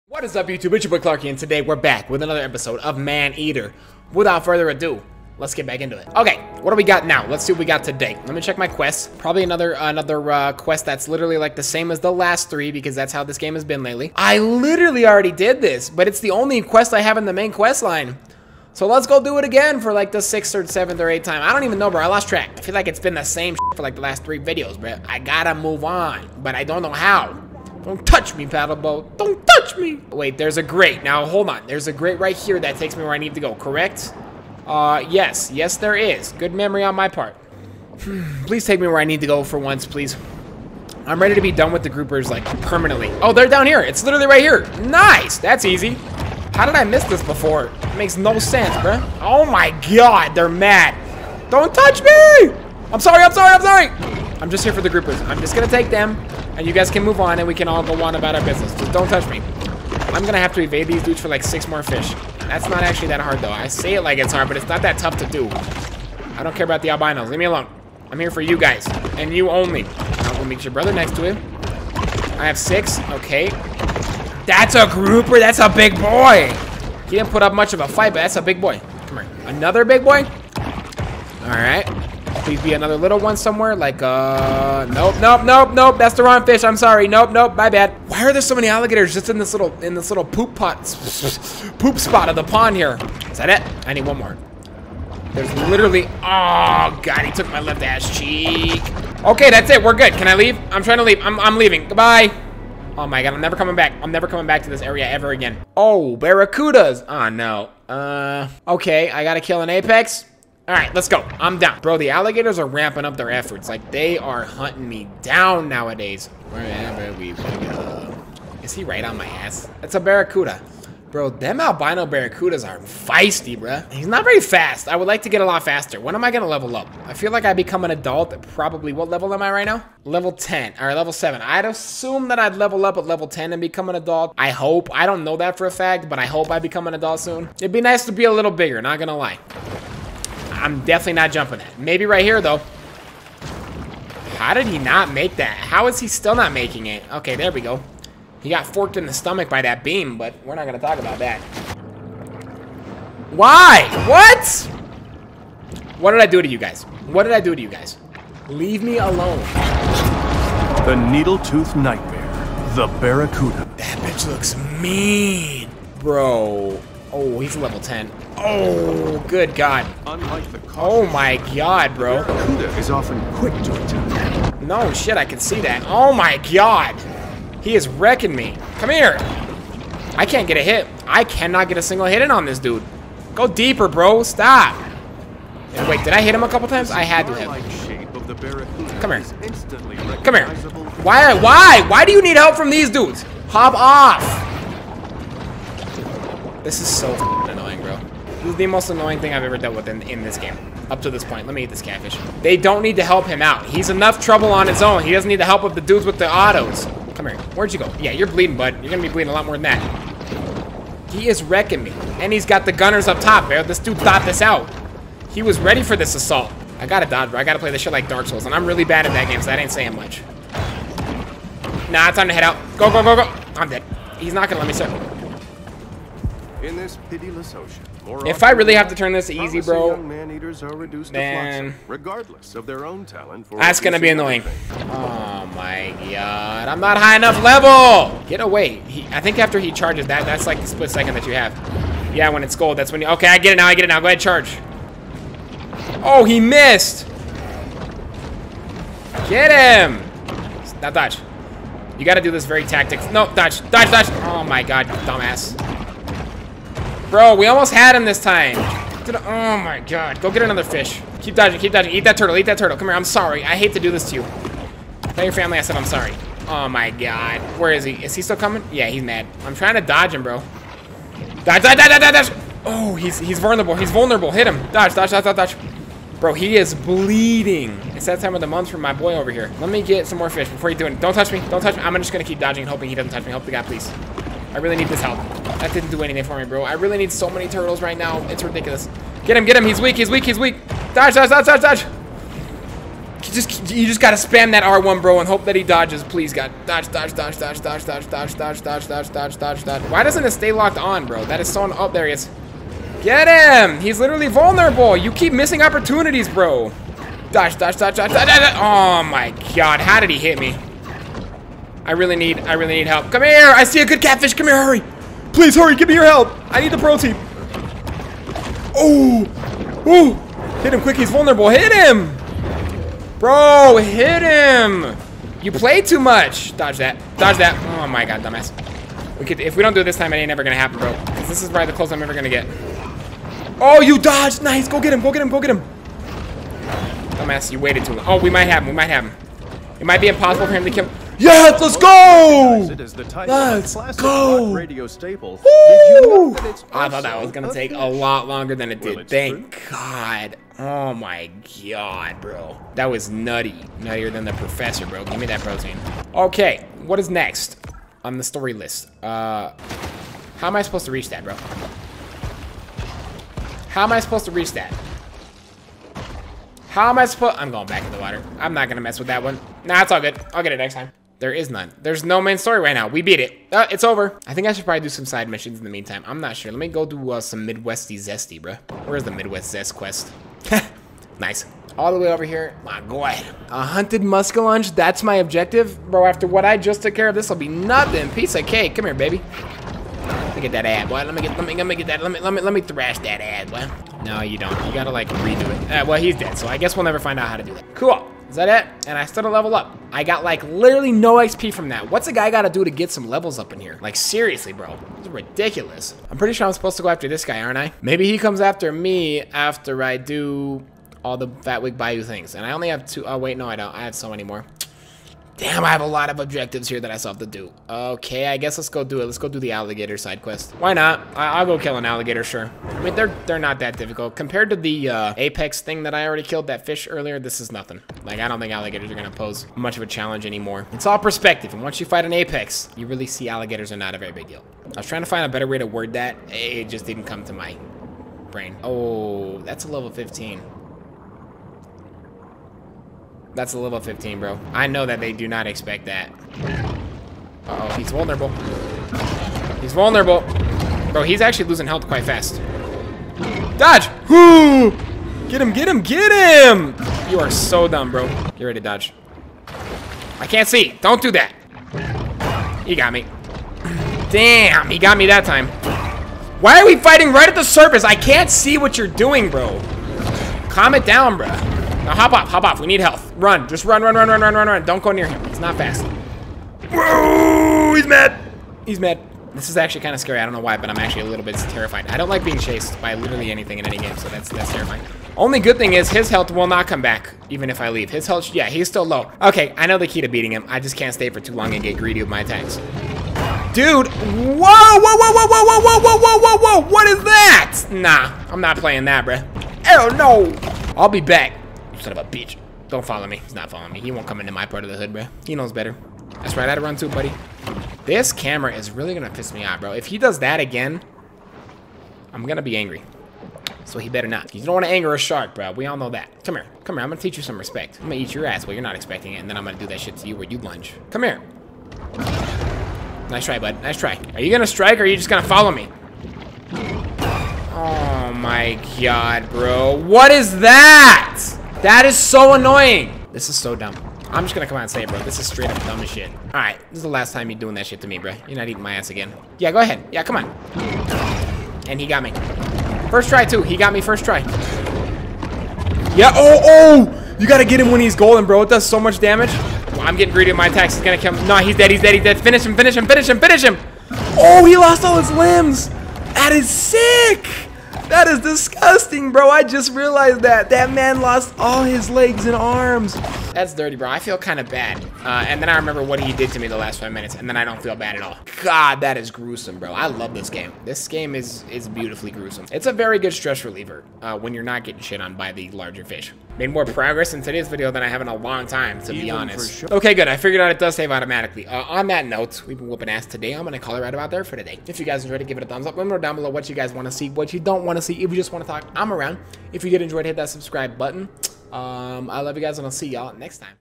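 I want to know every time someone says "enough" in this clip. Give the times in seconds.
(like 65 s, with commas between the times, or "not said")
203 s, 237 s.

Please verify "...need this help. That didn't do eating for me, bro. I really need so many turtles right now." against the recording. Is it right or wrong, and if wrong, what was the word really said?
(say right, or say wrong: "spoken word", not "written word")
wrong: "anything", not "eating".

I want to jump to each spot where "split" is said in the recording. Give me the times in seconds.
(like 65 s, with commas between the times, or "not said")
240 s.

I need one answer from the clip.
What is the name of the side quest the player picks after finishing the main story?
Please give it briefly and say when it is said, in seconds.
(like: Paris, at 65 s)
Midwest zest, at 379 s.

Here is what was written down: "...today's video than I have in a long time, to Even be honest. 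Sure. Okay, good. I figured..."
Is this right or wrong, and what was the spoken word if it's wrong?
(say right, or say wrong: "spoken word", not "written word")
right.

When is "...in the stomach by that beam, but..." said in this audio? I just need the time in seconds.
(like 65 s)
148 s.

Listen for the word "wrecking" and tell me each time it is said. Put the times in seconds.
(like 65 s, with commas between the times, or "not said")
177 s, 211 s.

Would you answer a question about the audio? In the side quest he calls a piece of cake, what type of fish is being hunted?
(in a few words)
Muskellunge.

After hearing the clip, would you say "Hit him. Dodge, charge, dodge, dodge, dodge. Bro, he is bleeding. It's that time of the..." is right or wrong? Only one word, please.
wrong.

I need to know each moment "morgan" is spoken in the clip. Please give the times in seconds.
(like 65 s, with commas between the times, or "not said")
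not said.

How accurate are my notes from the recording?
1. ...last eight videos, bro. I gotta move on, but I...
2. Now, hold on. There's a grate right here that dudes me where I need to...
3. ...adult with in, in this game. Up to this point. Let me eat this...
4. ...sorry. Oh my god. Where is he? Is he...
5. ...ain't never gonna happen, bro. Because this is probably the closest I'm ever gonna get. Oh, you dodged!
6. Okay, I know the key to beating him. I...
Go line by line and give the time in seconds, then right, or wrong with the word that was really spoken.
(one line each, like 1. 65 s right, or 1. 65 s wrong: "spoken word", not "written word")
1. 24 s wrong: "three", not "eight"
2. 31 s wrong: "takes", not "dudes"
3. 199 s wrong: "dealt", not "adult"
4. 265 s right
5. 330 s right
6. 489 s right.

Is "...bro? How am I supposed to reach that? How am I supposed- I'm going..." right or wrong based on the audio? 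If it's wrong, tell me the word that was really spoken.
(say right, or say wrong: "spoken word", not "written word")
right.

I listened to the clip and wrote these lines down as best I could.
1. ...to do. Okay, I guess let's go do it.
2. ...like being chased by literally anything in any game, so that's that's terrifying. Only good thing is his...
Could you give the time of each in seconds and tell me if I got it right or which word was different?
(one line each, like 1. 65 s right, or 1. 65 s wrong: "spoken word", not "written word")
1. 417 s right
2. 482 s right.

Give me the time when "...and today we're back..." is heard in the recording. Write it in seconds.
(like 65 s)
1 s.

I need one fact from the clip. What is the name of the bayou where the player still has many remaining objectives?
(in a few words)
Fawtick Bayou.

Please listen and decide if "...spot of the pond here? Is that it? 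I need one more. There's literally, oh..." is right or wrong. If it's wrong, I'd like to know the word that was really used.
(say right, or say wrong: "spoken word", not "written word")
right.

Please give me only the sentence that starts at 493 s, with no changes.
Dude, whoa, whoa, whoa, whoa, whoa, whoa, whoa, whoa, whoa, whoa, whoa, what is that?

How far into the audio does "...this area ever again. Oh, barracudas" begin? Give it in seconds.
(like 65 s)
104 s.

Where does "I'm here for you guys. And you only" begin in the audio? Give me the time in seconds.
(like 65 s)
68 s.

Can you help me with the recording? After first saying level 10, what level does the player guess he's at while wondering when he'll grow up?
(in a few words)
7.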